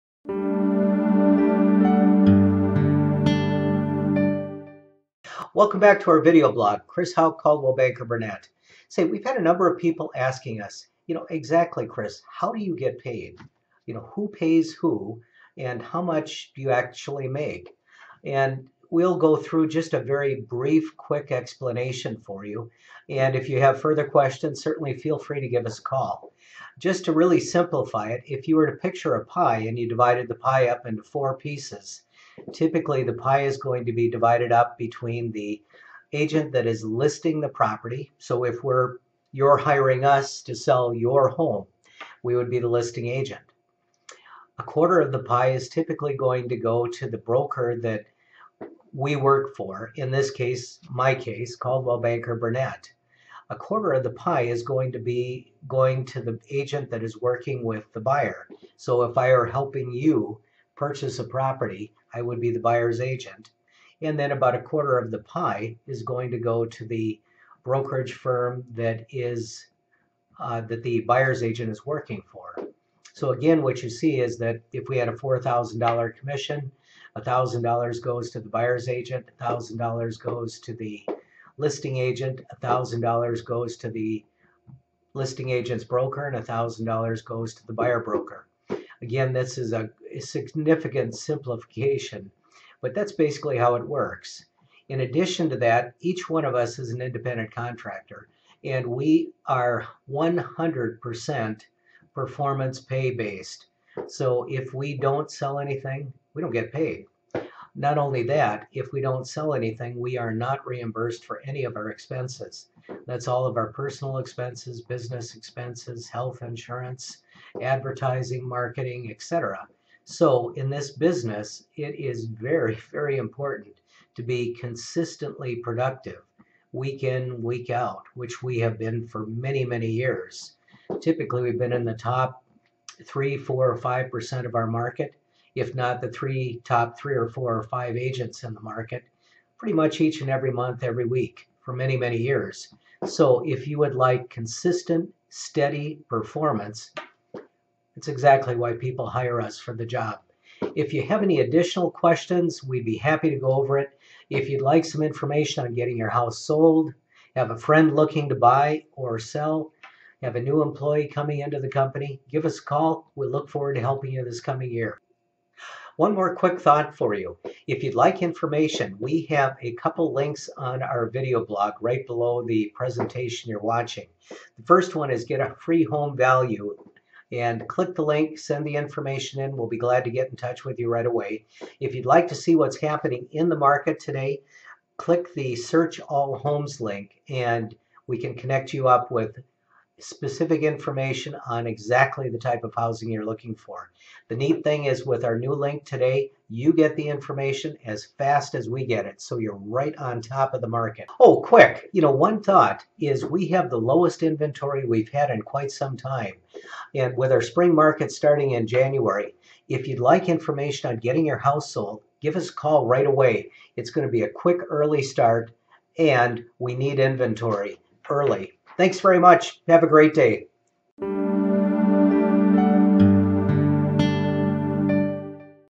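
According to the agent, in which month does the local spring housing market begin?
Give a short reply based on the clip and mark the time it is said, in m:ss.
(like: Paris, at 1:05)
January, at 3:28.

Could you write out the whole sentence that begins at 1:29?
Again, this is a significant simplification, but that's basically how it works.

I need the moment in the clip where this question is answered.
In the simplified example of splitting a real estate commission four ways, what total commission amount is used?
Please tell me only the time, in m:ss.
1:15.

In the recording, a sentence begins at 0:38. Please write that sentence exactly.
So if we're you're hiring us to sell your home, we would be the listing agent.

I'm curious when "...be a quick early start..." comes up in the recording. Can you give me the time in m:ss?
3:34.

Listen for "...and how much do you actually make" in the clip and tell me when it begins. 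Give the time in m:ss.
0:15.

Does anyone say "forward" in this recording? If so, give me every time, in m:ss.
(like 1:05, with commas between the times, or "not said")
2:43.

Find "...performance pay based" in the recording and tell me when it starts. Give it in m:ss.
1:42.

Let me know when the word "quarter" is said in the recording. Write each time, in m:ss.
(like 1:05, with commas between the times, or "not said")
0:44, 0:53, 1:04.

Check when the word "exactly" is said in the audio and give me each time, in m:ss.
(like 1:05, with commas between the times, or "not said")
0:11, 2:28, 3:11.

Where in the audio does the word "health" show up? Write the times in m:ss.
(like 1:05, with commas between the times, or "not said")
1:56.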